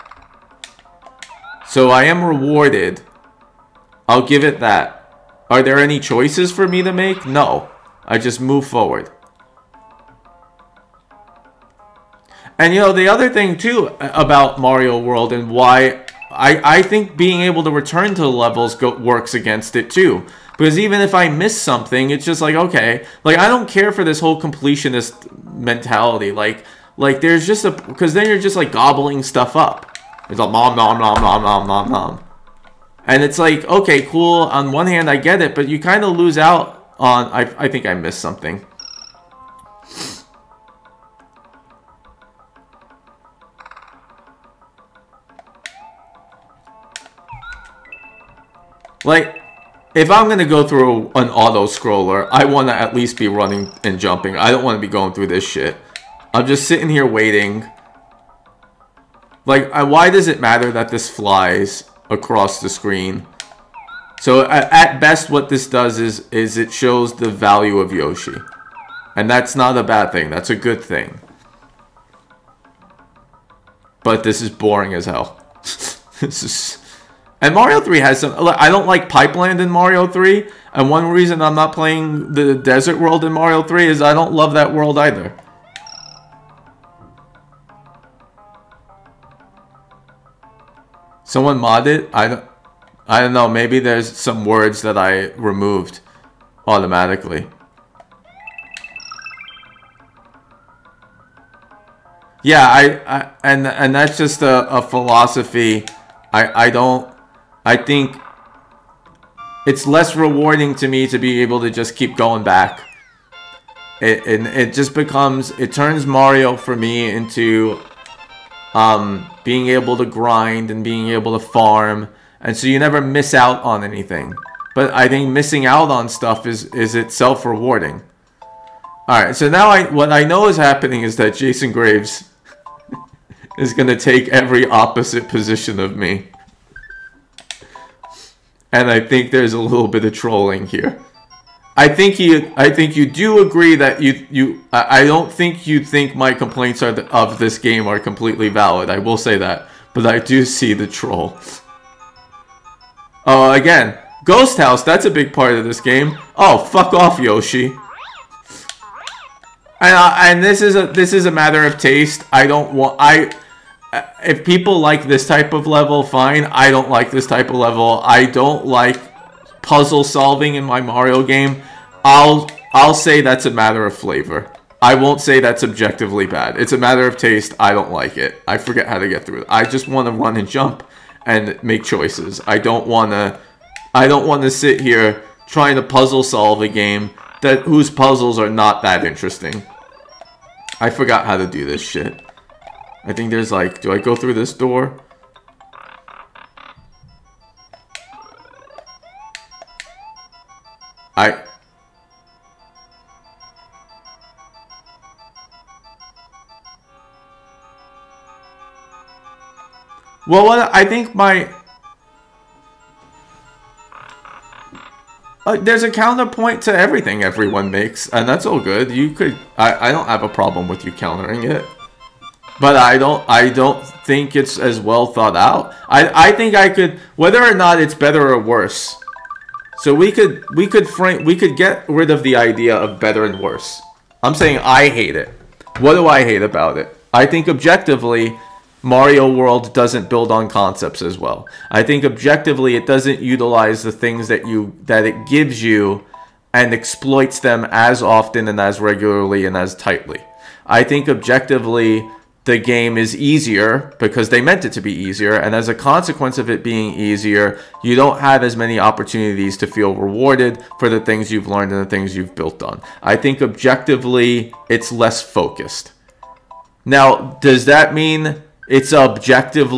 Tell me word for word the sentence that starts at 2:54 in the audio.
I won't say that's objectively bad.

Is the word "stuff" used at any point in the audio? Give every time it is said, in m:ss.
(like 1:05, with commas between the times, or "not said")
0:29, 2:06.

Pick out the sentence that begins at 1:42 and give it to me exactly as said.
Yeah, I, I and and that's just a, a philosophy.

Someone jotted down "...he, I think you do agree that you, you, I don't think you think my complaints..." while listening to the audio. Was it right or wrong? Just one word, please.
right.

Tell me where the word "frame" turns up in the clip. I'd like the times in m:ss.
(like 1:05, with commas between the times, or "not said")
3:50.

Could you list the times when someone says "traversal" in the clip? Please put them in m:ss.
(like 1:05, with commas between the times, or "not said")
not said.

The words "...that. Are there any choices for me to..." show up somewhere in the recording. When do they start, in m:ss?
0:04.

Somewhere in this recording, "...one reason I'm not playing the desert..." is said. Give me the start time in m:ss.
1:20.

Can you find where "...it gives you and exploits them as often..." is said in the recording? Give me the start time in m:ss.
4:05.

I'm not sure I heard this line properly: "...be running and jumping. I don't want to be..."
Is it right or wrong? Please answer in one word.
right.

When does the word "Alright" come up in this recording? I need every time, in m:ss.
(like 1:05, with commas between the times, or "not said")
2:09.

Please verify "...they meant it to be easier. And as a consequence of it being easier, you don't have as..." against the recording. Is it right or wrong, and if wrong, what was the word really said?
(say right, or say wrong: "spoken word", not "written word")
right.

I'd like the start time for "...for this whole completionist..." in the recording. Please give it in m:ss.
0:23.